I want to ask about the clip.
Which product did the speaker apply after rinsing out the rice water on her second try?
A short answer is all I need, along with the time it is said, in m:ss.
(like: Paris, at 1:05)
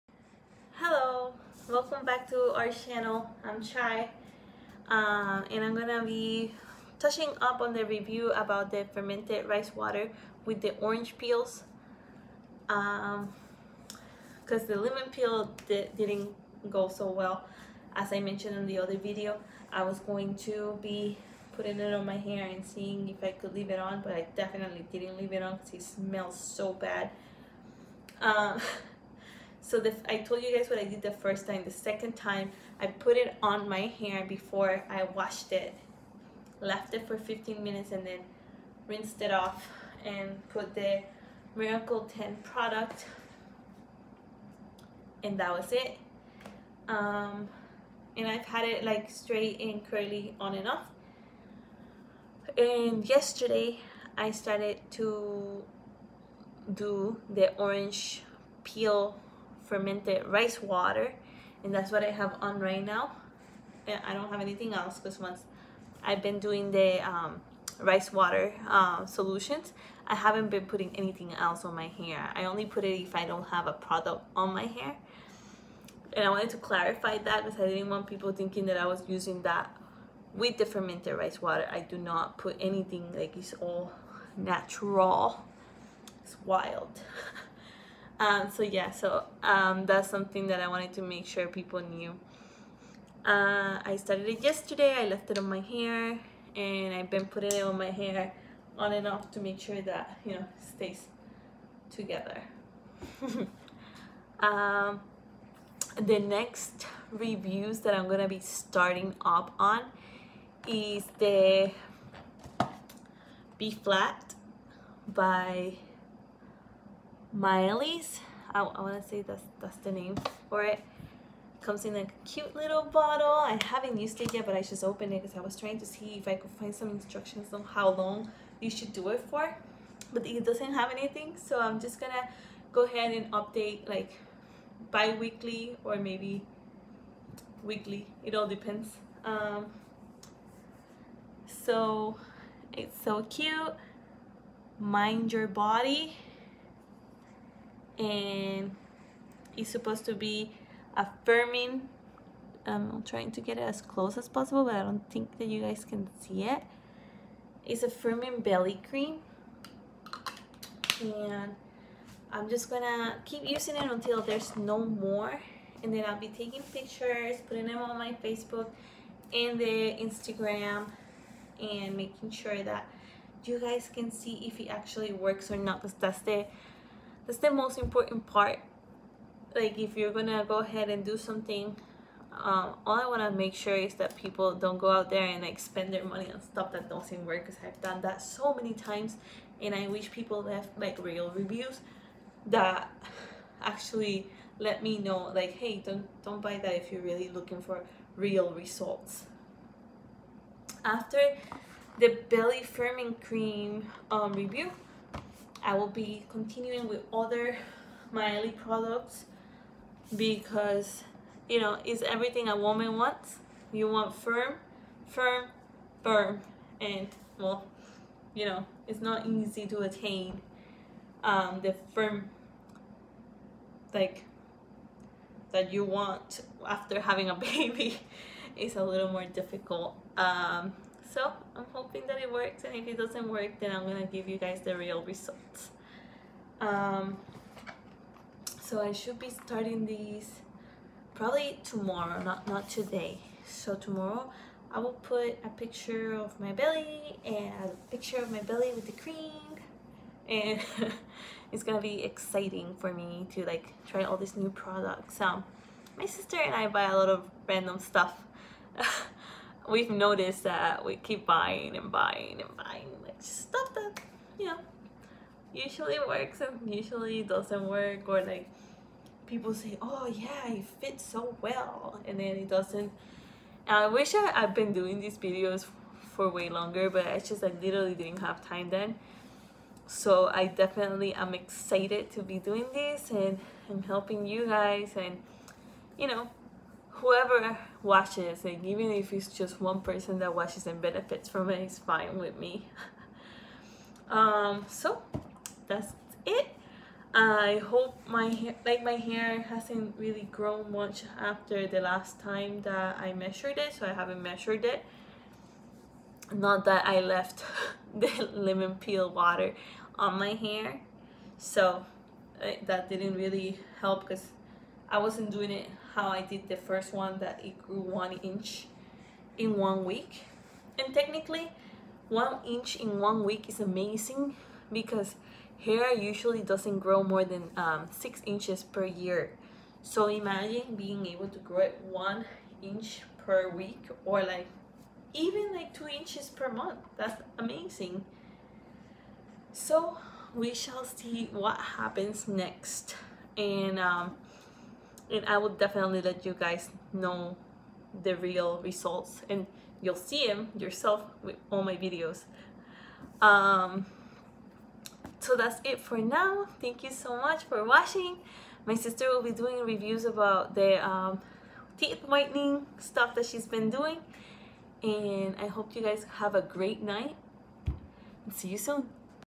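Miracle 10, at 0:41.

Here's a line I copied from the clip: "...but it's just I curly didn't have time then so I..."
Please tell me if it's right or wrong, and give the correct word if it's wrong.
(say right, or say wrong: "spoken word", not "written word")
wrong: "literally", not "curly".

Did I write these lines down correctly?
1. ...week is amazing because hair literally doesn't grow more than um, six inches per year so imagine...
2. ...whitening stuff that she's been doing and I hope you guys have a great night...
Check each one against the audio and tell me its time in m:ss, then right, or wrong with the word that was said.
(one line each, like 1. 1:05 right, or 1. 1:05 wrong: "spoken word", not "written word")
1. 5:23 wrong: "usually", not "literally"
2. 6:02 right.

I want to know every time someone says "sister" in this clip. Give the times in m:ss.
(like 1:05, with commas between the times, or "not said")
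4:16, 5:58.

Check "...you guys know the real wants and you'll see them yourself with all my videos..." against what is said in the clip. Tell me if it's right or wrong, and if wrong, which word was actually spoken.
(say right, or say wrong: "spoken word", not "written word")
wrong: "results", not "wants".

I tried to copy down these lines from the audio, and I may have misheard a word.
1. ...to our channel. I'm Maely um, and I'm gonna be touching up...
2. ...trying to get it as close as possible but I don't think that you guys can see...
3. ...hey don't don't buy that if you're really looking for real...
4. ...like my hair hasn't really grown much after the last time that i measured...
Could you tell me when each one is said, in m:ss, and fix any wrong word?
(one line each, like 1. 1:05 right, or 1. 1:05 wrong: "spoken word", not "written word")
1. 0:02 wrong: "Shy", not "Maely"
2. 2:33 right
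3. 3:15 right
4. 4:58 right.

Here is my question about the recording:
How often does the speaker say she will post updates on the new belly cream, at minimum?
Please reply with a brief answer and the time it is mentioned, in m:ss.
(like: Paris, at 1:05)
bi-weekly, at 2:14.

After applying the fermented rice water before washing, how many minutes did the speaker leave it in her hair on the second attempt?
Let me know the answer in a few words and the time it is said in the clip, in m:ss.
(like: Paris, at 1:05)
15, at 0:37.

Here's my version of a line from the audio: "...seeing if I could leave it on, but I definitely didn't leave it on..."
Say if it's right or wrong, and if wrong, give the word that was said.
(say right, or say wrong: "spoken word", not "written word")
right.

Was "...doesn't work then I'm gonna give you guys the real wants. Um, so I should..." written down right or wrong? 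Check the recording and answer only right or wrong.
wrong.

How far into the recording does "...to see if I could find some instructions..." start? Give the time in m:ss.
2:05.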